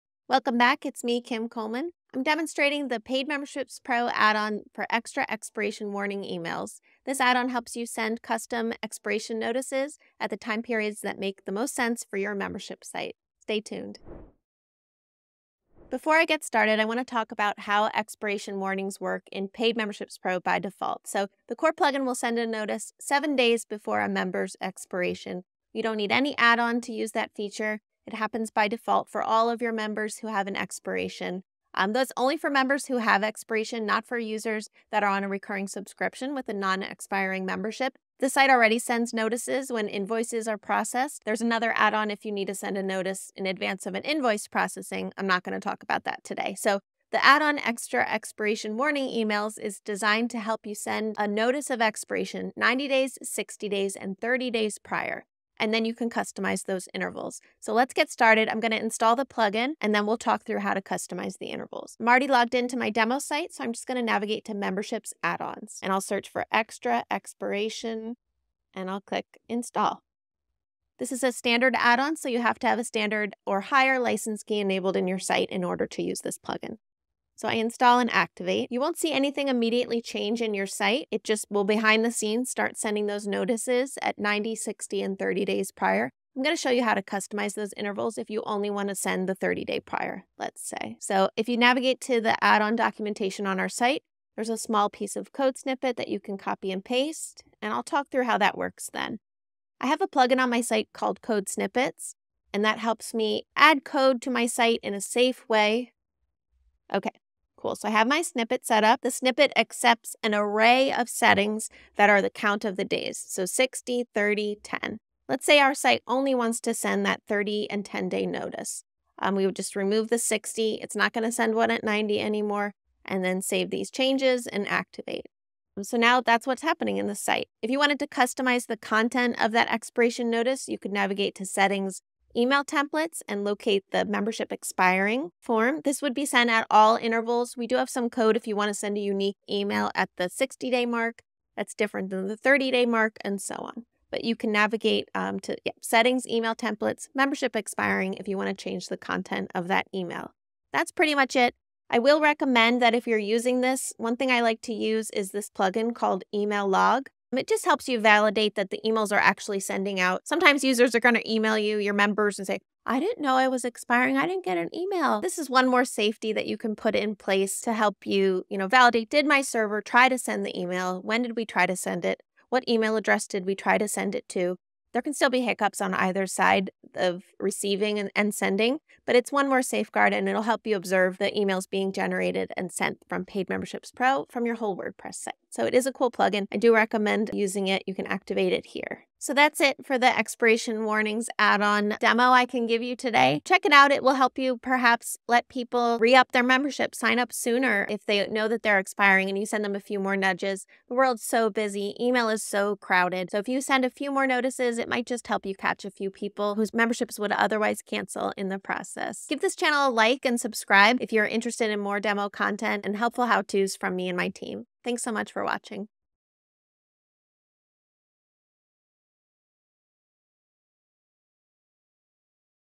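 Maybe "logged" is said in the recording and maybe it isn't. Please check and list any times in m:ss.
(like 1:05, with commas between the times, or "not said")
1:02.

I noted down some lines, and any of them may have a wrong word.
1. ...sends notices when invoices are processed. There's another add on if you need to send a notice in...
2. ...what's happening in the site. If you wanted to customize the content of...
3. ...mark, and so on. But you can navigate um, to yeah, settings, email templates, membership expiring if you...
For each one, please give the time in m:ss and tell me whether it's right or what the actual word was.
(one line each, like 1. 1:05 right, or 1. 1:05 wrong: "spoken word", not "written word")
1. 0:38 right
2. 2:06 right
3. 2:22 right.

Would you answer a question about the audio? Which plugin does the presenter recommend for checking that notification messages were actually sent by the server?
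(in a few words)
Email Log.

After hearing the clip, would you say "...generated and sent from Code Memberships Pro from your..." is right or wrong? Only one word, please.
wrong.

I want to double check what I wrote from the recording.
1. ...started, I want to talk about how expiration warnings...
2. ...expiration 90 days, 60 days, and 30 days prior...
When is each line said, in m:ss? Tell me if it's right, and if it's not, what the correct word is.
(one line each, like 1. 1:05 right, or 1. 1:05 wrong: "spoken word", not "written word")
1. 0:16 right
2. 0:51 right.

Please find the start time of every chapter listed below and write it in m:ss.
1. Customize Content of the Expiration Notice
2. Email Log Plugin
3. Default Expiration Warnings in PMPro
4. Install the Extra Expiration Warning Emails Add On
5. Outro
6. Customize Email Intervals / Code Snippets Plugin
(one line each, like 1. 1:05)
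1. 2:07
2. 2:31
3. 0:15
4. 1:02
5. 3:09
6. 1:26.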